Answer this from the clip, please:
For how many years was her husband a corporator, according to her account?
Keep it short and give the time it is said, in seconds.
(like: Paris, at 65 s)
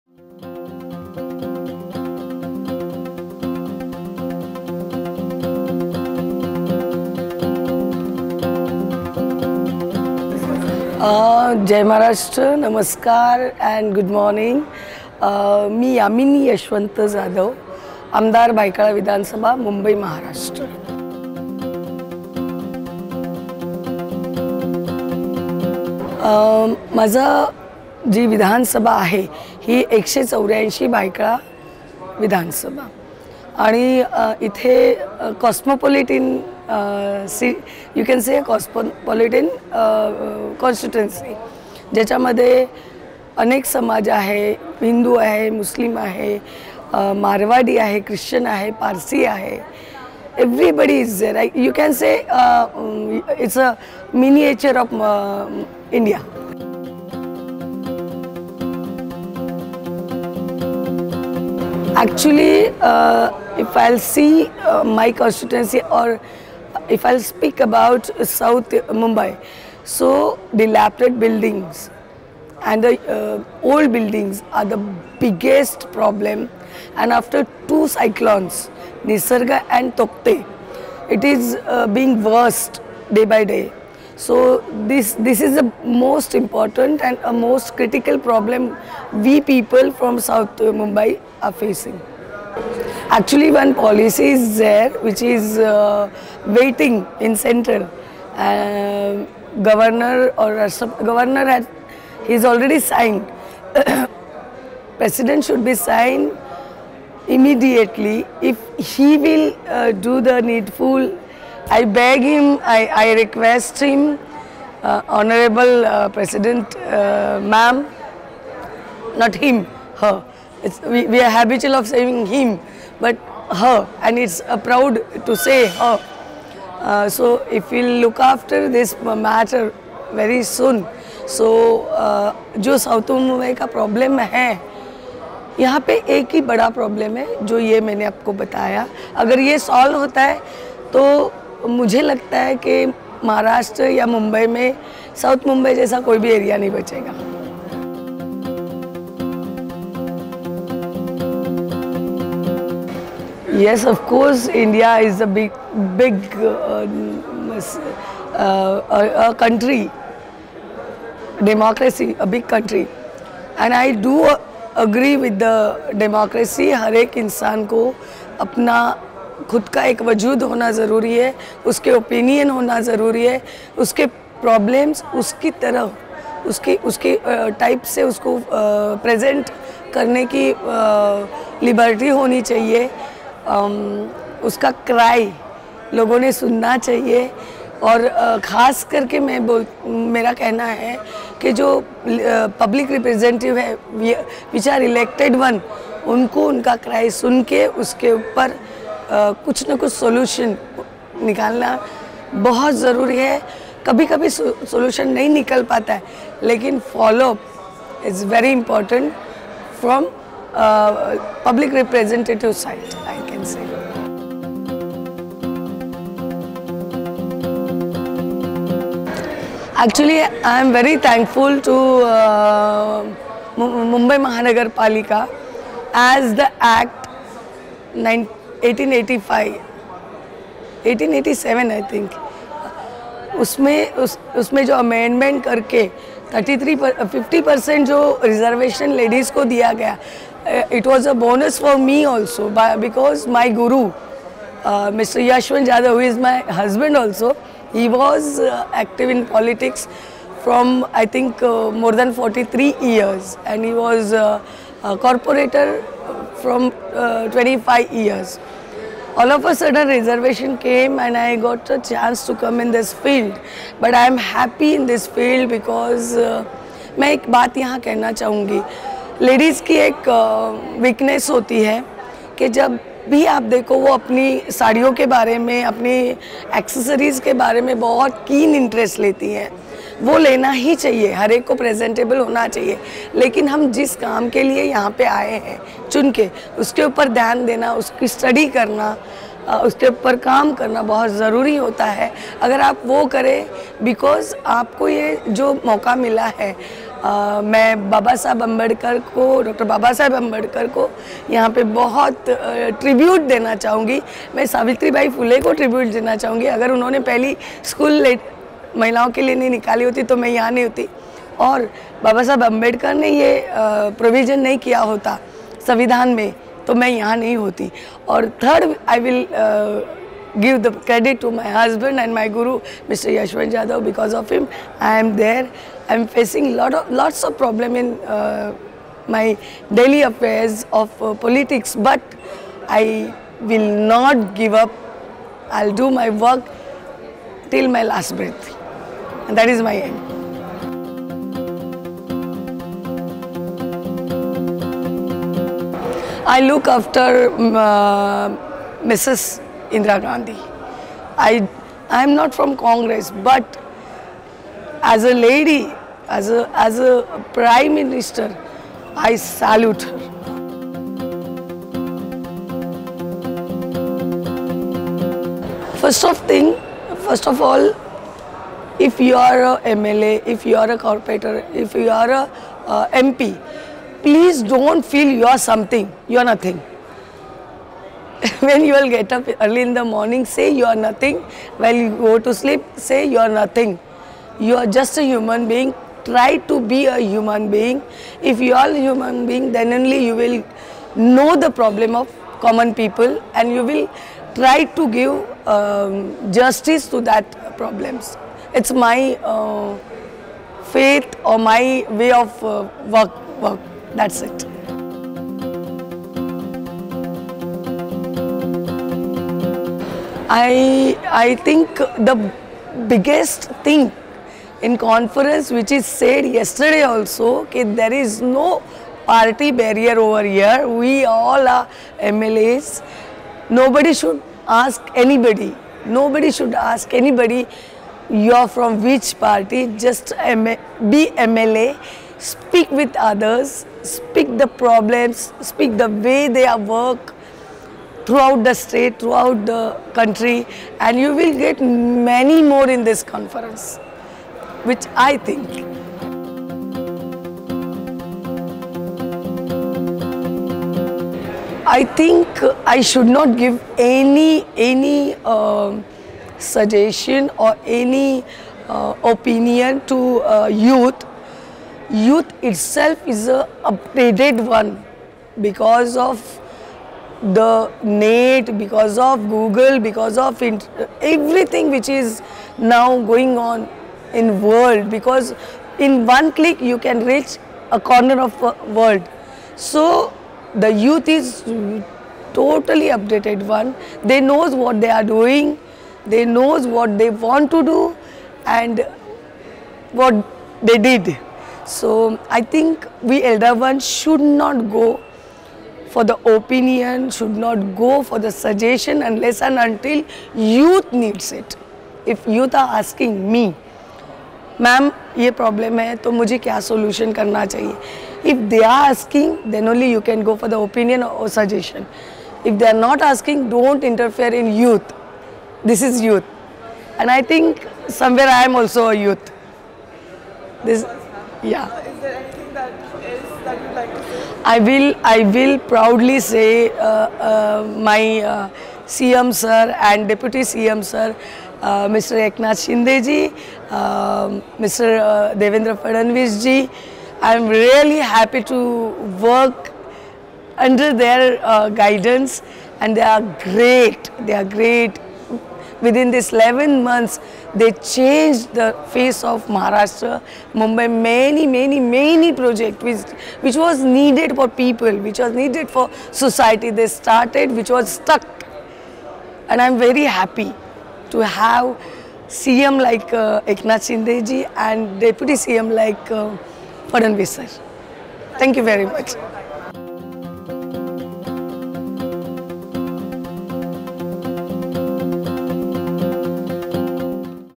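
25 years, at 257 s.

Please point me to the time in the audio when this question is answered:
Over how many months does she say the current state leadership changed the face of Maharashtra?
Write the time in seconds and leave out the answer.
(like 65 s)
546 s.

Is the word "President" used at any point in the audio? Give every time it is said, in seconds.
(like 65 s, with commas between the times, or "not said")
105 s, 116 s.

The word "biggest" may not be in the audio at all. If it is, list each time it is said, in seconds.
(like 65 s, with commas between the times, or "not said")
75 s, 412 s.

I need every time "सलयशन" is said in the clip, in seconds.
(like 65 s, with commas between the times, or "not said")
199 s, 204 s.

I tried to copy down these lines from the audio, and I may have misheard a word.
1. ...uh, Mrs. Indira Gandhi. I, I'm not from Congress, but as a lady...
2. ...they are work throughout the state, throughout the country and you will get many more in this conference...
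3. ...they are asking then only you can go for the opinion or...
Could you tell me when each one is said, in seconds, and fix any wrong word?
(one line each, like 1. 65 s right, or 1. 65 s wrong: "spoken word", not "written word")
1. 347 s right
2. 436 s right
3. 508 s right.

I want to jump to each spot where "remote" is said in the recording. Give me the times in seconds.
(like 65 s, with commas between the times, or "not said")
not said.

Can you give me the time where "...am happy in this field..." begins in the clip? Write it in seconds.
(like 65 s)
264 s.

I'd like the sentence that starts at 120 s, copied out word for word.
It's, we, we are habitual of saying him.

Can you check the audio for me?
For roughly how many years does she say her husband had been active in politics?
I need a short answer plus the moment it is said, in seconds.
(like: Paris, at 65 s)
More than 43 years, at 251 s.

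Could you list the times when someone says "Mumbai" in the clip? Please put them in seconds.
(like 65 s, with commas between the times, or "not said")
68 s, 90 s, 223 s, 550 s.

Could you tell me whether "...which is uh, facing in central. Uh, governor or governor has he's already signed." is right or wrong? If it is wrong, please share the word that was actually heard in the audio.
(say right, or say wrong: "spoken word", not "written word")
wrong: "waiting", not "facing".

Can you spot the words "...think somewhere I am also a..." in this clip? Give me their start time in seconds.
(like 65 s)
517 s.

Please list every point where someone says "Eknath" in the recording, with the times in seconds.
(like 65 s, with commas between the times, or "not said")
532 s, 563 s.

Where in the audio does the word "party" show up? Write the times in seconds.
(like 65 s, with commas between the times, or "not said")
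419 s, 429 s.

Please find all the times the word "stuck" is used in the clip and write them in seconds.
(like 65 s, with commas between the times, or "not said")
557 s.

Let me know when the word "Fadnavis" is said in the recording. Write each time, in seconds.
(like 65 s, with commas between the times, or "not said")
535 s, 566 s.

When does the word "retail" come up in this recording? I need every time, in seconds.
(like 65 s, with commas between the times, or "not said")
not said.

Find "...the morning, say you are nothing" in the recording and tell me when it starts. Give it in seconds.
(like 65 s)
379 s.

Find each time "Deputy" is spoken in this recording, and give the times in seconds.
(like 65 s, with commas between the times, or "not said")
530 s, 564 s.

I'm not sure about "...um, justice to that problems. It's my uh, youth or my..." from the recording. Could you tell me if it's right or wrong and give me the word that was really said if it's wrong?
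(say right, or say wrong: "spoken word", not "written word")
wrong: "faith", not "youth".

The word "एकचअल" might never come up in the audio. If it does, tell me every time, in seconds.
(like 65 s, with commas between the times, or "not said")
62 s, 219 s.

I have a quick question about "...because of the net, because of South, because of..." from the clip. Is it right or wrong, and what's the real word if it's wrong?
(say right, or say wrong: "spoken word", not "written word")
wrong: "Google", not "South".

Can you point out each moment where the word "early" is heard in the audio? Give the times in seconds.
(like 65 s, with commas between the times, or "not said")
379 s.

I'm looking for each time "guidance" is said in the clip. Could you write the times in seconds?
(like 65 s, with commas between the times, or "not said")
541 s.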